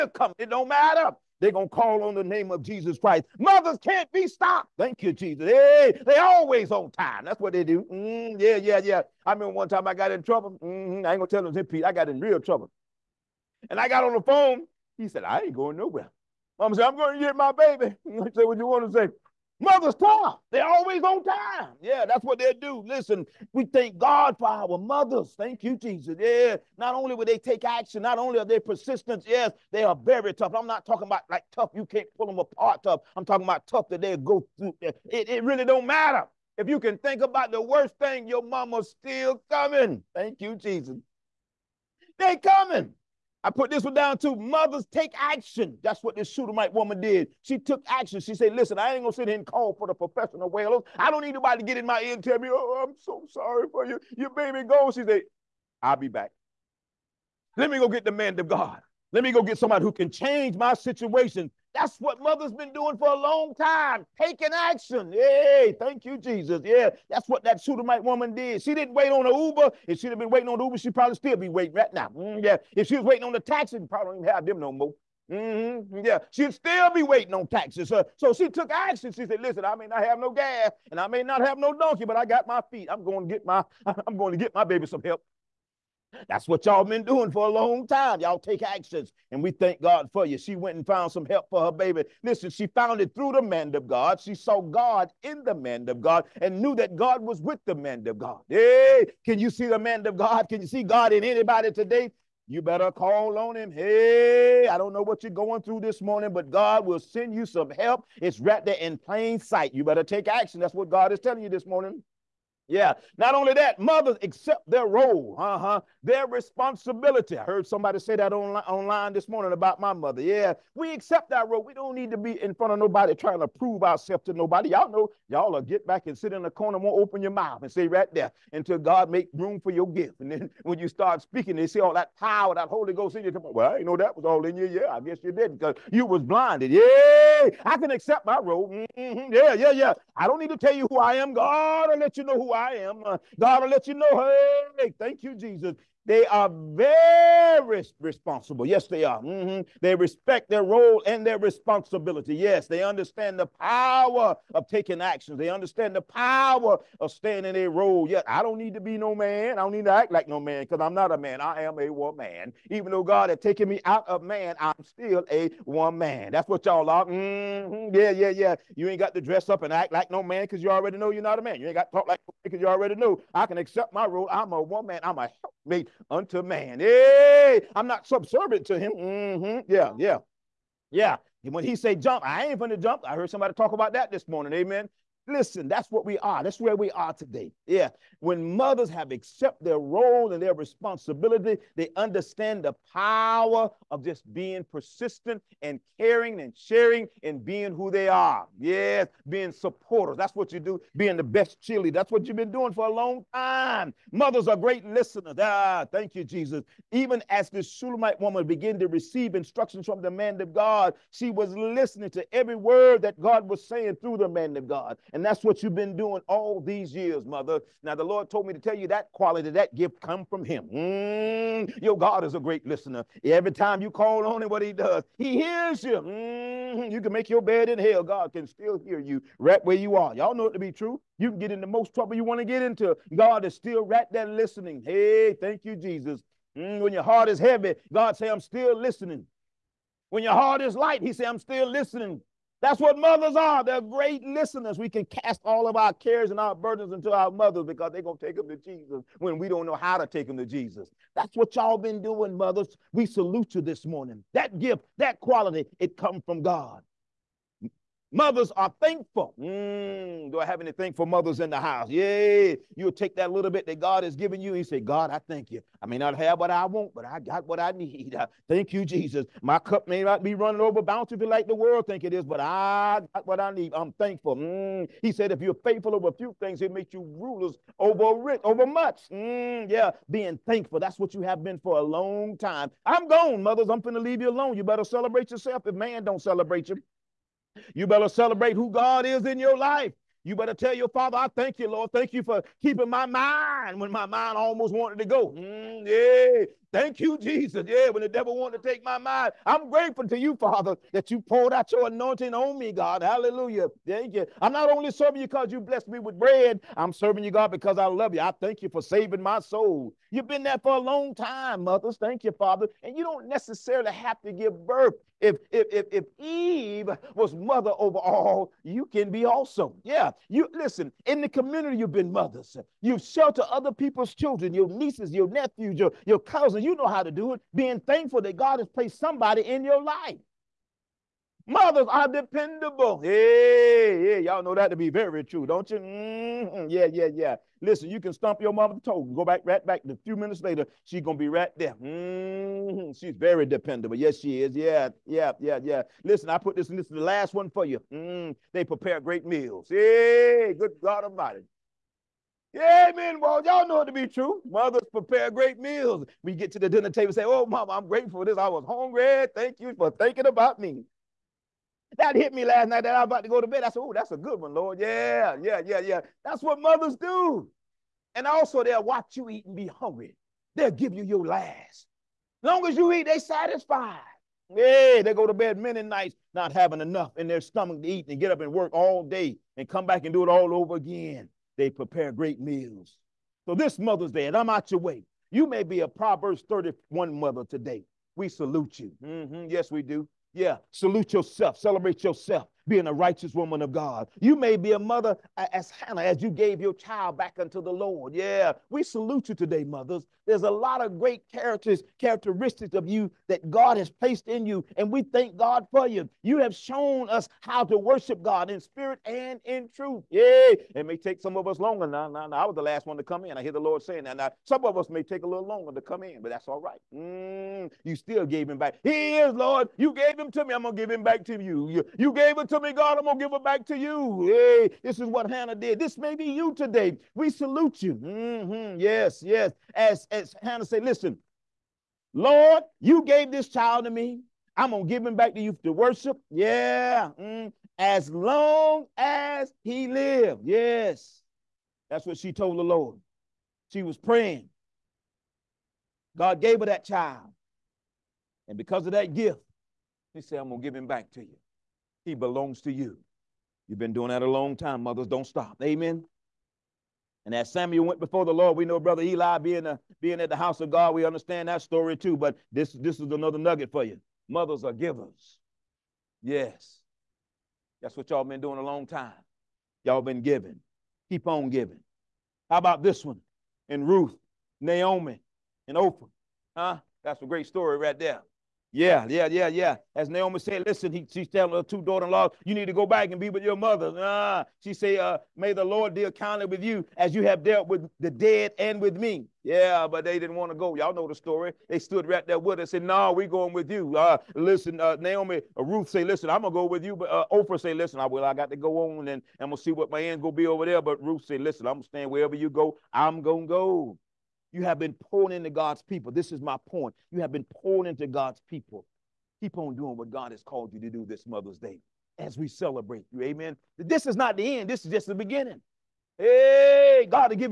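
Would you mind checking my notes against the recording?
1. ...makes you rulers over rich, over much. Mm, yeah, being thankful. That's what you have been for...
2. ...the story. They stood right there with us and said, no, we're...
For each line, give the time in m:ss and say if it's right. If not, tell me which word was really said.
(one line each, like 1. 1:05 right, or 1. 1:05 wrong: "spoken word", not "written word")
1. 4:36 right
2. 8:11 right.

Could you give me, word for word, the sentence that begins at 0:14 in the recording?
He said, I ain't going nowhere.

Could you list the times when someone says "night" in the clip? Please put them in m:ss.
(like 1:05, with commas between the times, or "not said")
6:02, 6:15.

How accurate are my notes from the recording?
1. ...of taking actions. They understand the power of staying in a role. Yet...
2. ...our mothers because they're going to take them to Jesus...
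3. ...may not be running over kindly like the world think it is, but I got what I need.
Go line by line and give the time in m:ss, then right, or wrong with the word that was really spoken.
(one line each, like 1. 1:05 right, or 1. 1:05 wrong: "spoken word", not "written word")
1. 2:34 right
2. 4:07 right
3. 4:29 wrong: "bountifully", not "kindly".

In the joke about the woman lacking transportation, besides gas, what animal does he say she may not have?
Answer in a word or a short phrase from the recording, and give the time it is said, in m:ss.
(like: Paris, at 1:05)
donkey, at 1:21.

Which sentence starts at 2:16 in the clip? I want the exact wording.
Yeah, I can accept my role.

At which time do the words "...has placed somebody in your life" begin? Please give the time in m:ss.
5:28.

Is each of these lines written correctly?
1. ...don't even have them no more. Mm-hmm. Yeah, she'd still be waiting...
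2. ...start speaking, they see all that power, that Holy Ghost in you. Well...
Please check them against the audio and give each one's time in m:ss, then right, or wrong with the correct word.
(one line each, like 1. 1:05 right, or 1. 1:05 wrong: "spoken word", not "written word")
1. 1:14 right
2. 2:10 right.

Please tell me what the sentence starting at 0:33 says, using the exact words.
I'm talking about tough that they go through.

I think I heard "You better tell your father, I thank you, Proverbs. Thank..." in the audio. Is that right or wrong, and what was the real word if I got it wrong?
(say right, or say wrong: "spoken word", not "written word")
wrong: "Lord", not "Proverbs".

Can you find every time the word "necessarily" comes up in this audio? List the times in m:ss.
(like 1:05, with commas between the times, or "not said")
5:13.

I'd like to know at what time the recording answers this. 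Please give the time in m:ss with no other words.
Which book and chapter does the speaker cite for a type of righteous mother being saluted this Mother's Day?
6:25.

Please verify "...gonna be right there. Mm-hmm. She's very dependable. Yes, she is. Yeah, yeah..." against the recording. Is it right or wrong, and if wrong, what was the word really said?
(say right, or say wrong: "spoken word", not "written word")
right.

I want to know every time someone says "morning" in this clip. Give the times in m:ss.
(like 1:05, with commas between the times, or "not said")
1:46, 1:51, 1:59, 3:04, 4:13.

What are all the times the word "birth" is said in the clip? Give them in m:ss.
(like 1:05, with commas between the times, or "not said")
5:14.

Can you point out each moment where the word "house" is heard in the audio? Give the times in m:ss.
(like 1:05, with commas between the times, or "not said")
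4:21, 7:40.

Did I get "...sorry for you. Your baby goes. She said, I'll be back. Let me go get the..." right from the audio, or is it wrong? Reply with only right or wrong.
right.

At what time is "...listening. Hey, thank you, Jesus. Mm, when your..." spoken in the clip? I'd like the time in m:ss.
3:54.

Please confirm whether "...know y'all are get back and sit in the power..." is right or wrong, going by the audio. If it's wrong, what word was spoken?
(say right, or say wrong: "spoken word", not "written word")
wrong: "corner", not "power".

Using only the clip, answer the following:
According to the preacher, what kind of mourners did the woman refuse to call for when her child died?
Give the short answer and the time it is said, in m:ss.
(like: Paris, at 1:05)
professional wailers, at 0:49.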